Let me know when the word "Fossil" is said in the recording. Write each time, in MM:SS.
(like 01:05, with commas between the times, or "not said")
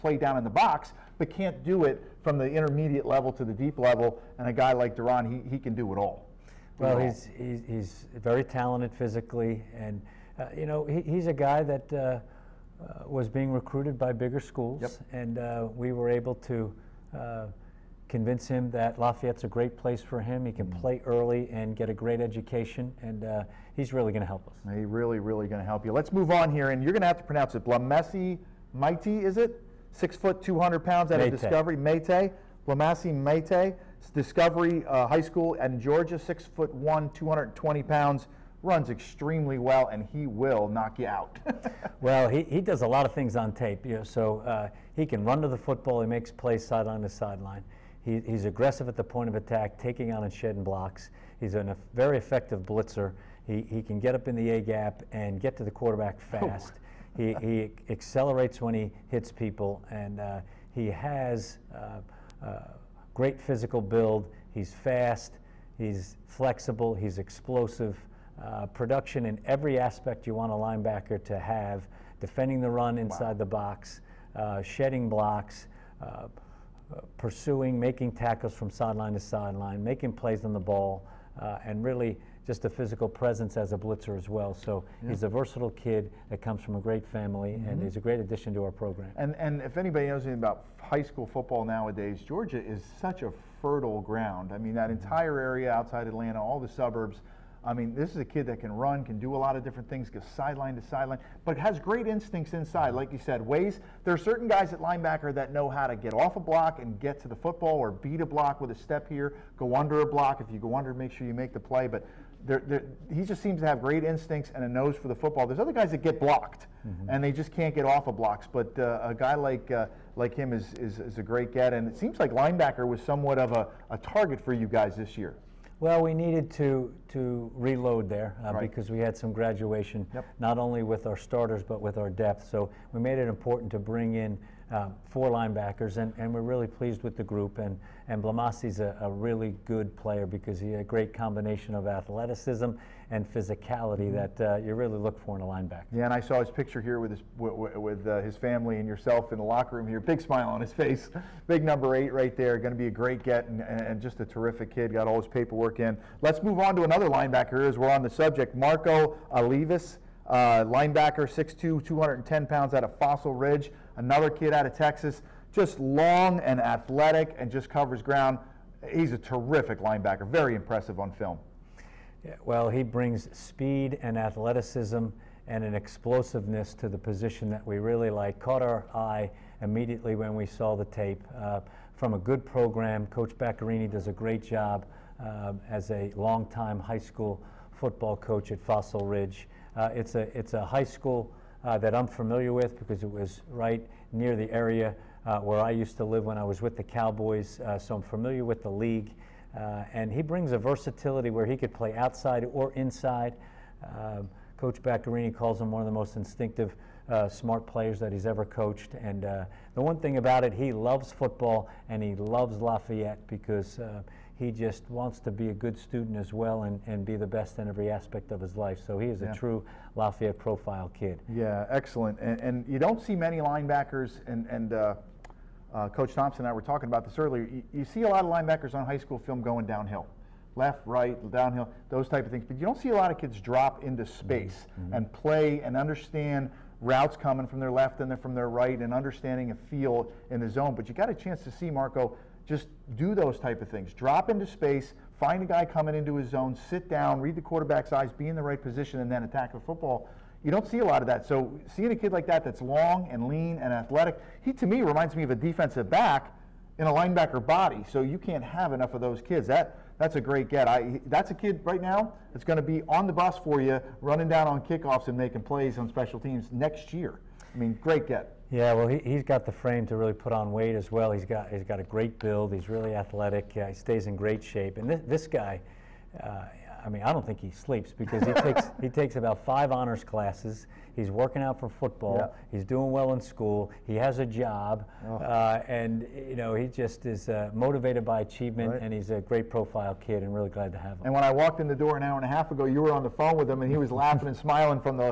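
02:42, 03:08.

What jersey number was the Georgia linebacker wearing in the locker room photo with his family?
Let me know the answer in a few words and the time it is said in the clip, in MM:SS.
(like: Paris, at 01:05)
8, at 02:31.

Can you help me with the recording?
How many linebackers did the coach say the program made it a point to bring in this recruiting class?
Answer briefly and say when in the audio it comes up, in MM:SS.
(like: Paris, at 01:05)
4, at 02:15.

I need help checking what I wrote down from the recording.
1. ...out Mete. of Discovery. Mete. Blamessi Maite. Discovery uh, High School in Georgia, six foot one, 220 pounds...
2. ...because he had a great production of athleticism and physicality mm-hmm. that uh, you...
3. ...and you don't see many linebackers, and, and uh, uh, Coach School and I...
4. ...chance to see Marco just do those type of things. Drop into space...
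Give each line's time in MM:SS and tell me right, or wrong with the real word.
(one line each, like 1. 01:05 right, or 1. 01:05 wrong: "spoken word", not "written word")
1. 00:31 right
2. 02:20 wrong: "combination", not "production"
3. 03:42 wrong: "Thompson", not "School"
4. 04:01 right.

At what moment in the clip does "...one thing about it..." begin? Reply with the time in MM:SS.
03:29.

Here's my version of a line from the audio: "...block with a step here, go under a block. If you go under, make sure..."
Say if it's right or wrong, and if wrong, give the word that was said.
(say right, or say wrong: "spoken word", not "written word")
right.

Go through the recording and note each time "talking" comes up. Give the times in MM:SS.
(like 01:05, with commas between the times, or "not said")
03:46.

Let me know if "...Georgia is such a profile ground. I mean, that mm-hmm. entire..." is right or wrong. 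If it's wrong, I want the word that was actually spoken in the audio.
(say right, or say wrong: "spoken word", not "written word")
wrong: "fertile", not "profile".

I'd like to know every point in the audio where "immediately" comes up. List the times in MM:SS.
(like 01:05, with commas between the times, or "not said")
02:59.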